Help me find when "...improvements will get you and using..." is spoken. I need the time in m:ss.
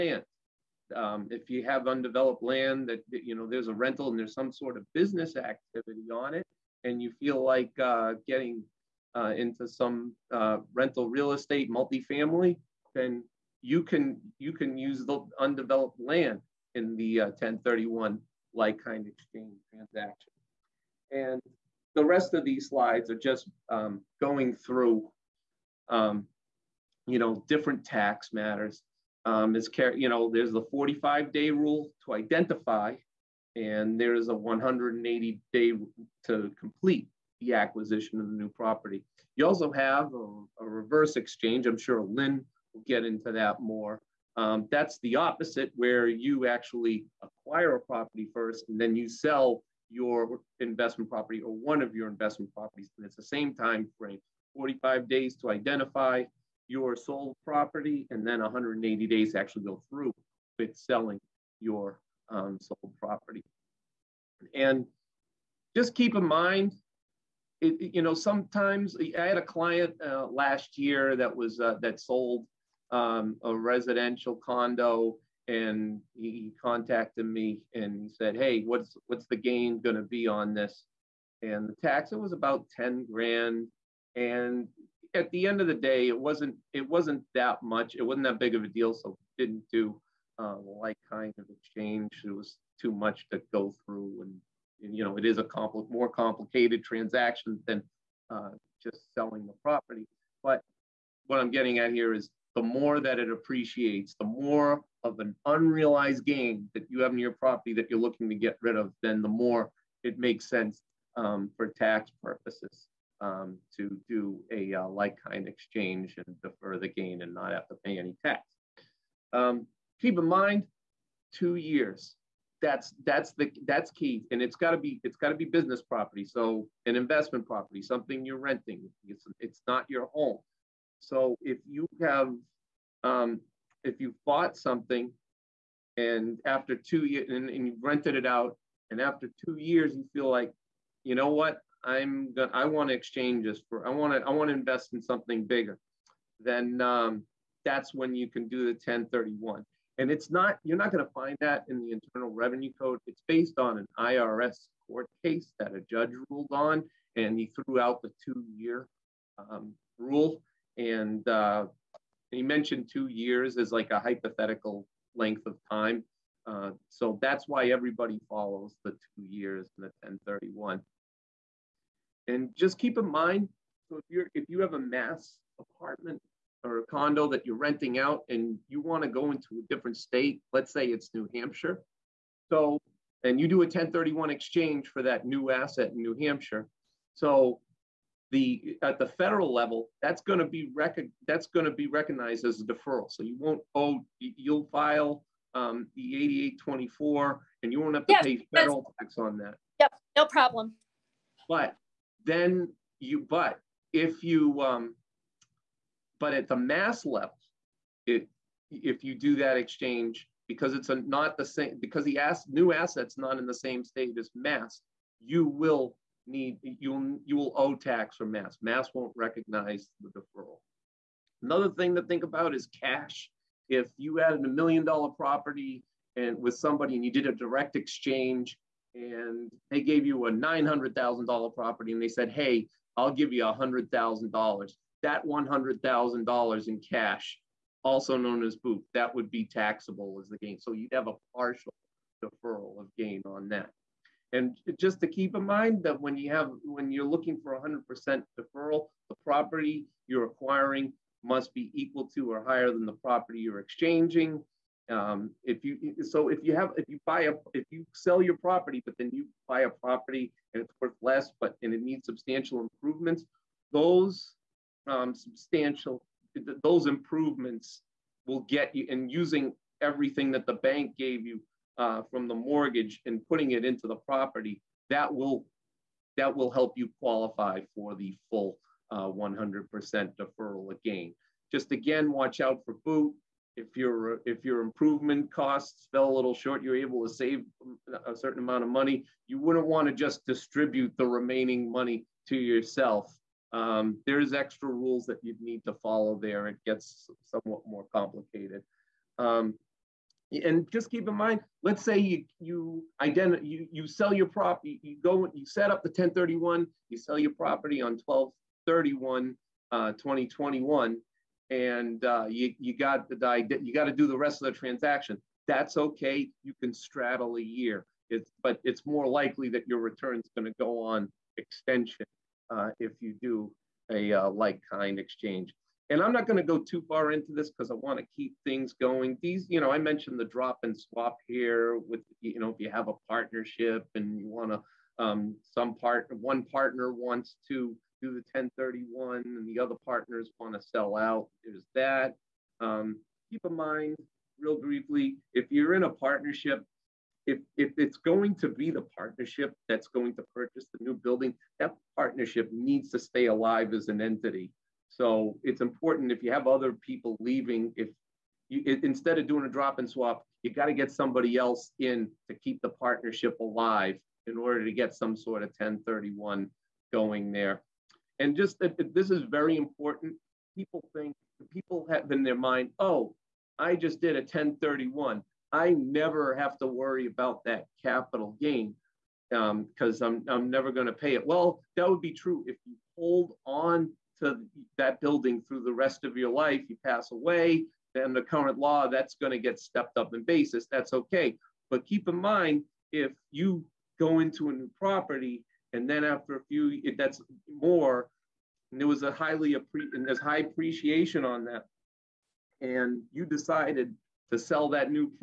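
4:26.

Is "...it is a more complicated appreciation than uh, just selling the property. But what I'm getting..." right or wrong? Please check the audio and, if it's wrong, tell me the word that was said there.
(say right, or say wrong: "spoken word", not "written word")
wrong: "transaction", not "appreciation".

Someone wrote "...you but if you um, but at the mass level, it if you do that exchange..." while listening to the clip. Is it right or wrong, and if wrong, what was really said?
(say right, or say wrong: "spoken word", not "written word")
right.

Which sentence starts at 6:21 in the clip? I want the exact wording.
Well, that would be true if you hold on to that building through the rest of your life.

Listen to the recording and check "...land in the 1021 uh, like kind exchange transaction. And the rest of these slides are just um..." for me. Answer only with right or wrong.
wrong.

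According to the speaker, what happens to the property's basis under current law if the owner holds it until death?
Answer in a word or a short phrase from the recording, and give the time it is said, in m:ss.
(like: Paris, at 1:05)
stepped up, at 6:29.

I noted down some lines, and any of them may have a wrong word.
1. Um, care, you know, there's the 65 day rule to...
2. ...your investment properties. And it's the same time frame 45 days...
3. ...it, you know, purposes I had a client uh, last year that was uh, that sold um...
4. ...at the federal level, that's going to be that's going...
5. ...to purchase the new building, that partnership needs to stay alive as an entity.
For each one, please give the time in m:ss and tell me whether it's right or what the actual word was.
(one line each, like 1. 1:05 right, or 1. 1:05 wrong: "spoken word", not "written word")
1. 0:29 wrong: "45", not "65"
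2. 0:51 right
3. 1:07 wrong: "sometimes", not "purposes"
4. 3:08 right
5. 5:50 right.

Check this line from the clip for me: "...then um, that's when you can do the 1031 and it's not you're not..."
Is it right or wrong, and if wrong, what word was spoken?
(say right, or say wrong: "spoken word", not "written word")
right.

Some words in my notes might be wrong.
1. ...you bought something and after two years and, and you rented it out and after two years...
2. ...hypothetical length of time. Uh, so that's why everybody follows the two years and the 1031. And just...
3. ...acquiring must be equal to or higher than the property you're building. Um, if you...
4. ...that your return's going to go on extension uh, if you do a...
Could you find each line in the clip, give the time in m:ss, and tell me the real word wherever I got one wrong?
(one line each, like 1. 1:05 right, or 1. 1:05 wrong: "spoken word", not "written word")
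1. 2:13 right
2. 2:43 right
3. 4:10 wrong: "exchanging", not "building"
4. 5:19 right.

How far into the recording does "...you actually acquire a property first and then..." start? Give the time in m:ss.
0:46.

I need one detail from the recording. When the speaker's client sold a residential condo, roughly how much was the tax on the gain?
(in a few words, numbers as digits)
$10,000.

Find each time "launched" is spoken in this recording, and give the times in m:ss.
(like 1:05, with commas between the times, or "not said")
not said.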